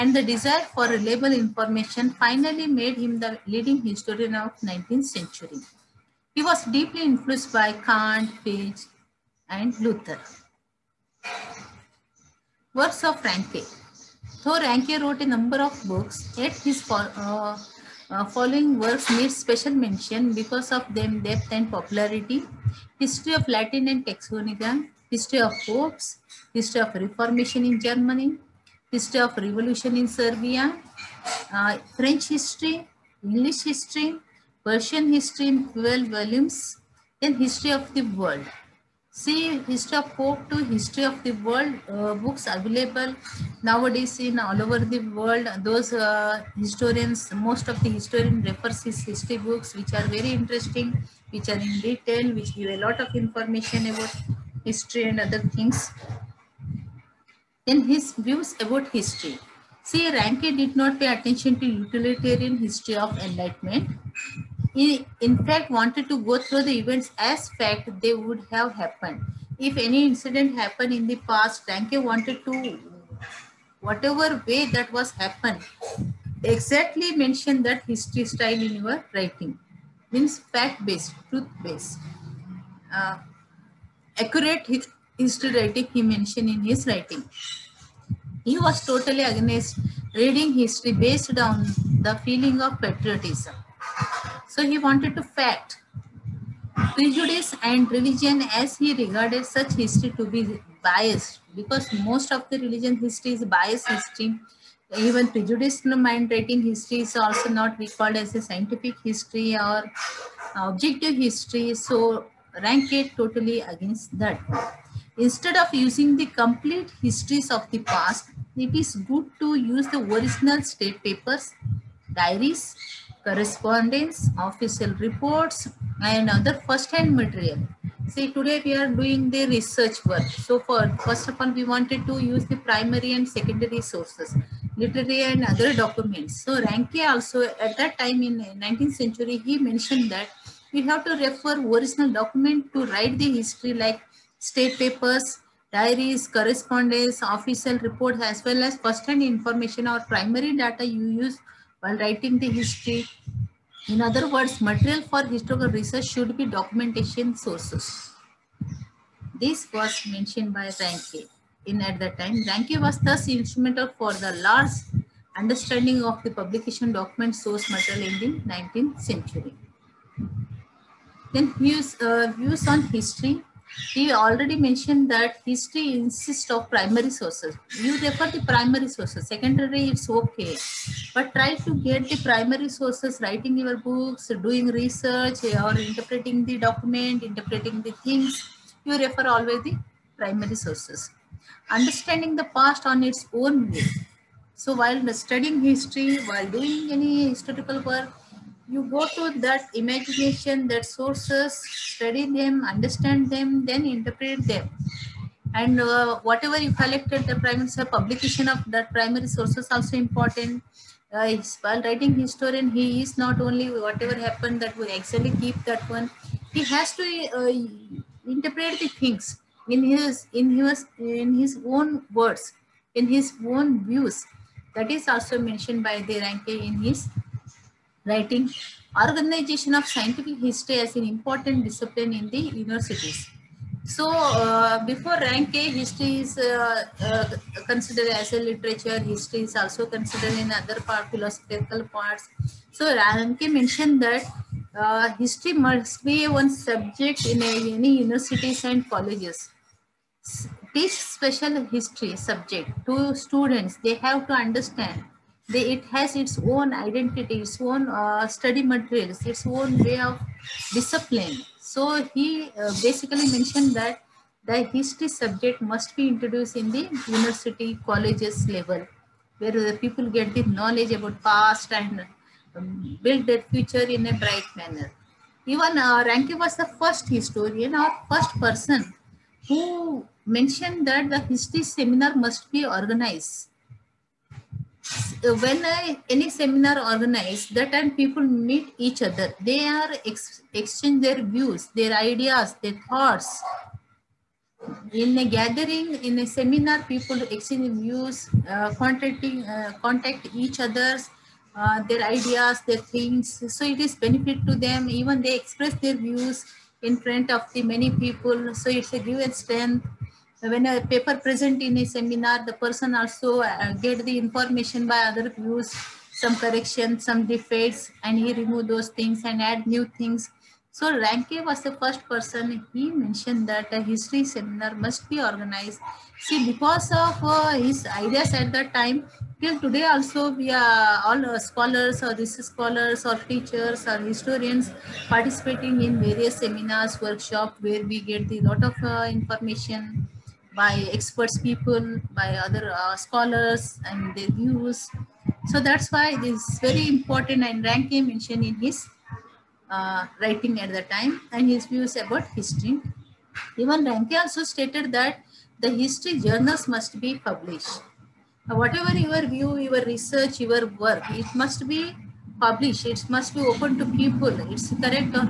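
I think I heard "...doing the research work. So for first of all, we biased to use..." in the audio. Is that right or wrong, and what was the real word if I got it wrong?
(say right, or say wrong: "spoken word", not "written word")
wrong: "wanted", not "biased".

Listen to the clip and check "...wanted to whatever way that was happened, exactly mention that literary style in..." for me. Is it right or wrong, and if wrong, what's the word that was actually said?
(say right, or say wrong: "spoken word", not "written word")
wrong: "history", not "literary".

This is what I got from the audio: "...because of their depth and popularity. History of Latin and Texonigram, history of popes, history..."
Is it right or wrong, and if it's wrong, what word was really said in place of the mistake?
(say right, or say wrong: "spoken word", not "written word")
right.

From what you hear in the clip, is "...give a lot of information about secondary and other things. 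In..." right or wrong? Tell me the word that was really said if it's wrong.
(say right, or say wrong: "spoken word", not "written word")
wrong: "history", not "secondary".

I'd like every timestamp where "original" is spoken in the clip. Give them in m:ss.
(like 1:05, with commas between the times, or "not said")
1:59, 2:21.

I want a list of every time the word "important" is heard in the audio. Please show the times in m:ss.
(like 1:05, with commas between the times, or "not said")
3:29, 3:51, 5:46.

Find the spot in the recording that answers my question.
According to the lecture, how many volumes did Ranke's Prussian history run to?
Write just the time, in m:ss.
0:35.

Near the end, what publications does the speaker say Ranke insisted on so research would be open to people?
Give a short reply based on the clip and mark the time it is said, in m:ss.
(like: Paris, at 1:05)
History journals, at 5:55.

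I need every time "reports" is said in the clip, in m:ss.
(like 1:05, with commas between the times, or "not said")
2:04, 2:27.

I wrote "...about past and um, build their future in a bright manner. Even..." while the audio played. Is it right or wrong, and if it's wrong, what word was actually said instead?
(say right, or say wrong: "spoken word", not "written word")
right.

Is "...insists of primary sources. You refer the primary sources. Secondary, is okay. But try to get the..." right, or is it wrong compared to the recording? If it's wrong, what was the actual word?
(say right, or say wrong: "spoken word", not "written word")
right.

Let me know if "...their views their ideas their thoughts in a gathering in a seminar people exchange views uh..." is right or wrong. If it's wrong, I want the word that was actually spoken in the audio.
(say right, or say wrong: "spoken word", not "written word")
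right.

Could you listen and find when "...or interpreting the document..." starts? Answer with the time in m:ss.
3:05.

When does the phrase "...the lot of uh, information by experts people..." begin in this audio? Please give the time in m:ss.
5:38.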